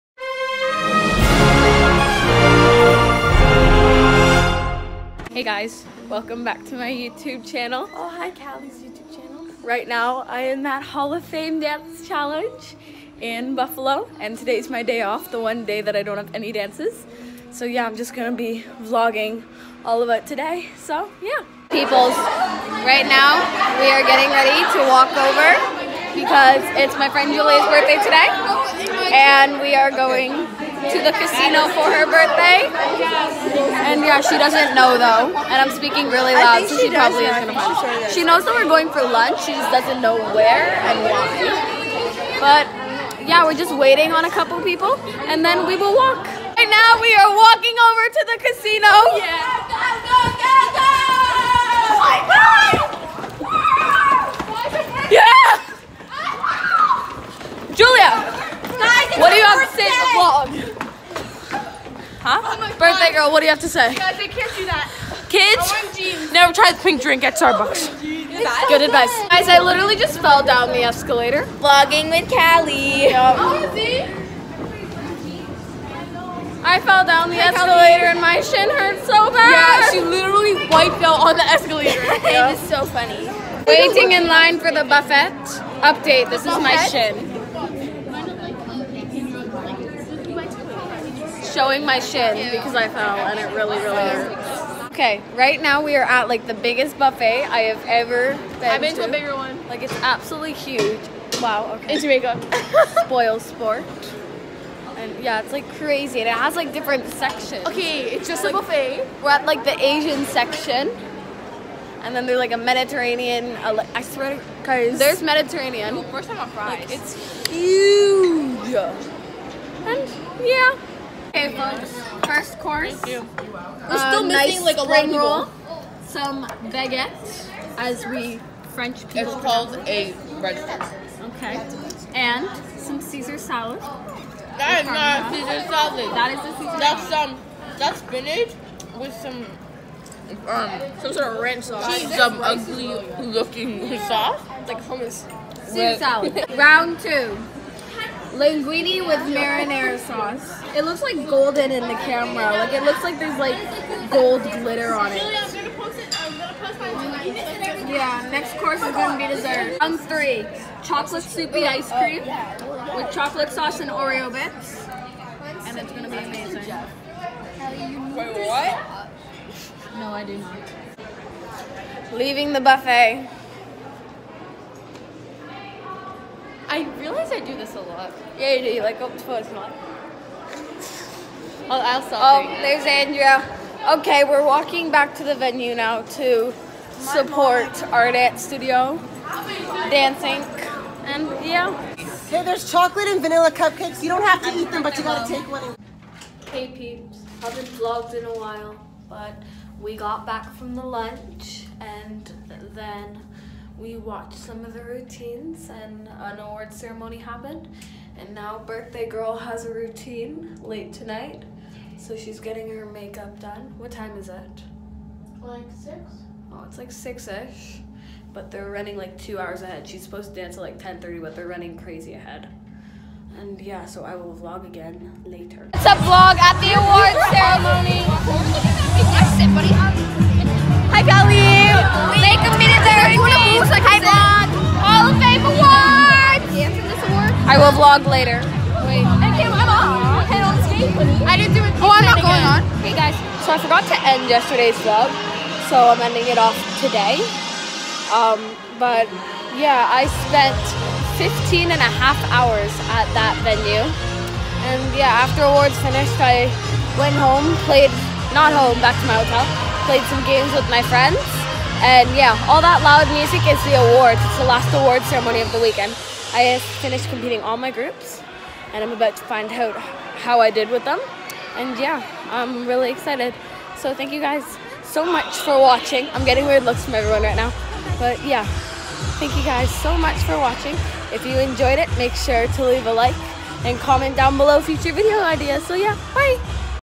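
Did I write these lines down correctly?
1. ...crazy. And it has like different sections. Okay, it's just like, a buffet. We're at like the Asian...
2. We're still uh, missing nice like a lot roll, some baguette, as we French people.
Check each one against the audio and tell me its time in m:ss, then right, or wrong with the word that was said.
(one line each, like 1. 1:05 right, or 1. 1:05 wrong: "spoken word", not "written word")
1. 1:45 right
2. 2:03 right.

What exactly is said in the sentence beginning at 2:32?
Like it looks like there's like gold glitter on it.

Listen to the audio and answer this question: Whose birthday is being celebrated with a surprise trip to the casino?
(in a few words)
Julia.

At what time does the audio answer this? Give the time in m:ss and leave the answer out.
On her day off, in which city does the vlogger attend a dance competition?
0:13.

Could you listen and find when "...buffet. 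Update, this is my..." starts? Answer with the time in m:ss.
1:24.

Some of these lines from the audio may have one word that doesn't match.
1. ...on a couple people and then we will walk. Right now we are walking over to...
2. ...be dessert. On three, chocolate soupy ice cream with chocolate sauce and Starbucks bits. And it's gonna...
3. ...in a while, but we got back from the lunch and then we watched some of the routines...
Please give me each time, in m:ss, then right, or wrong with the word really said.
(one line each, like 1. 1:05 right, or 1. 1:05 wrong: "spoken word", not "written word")
1. 0:44 right
2. 2:39 wrong: "Oreo", not "Starbucks"
3. 3:18 right.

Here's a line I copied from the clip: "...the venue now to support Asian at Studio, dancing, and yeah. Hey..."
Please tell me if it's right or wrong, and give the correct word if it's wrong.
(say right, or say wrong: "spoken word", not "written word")
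wrong: "Art", not "Asian".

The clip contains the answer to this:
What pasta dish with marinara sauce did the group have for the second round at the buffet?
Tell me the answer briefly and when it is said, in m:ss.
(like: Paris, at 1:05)
Linguini, at 2:28.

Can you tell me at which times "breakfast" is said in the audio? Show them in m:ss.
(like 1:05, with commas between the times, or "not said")
2:10.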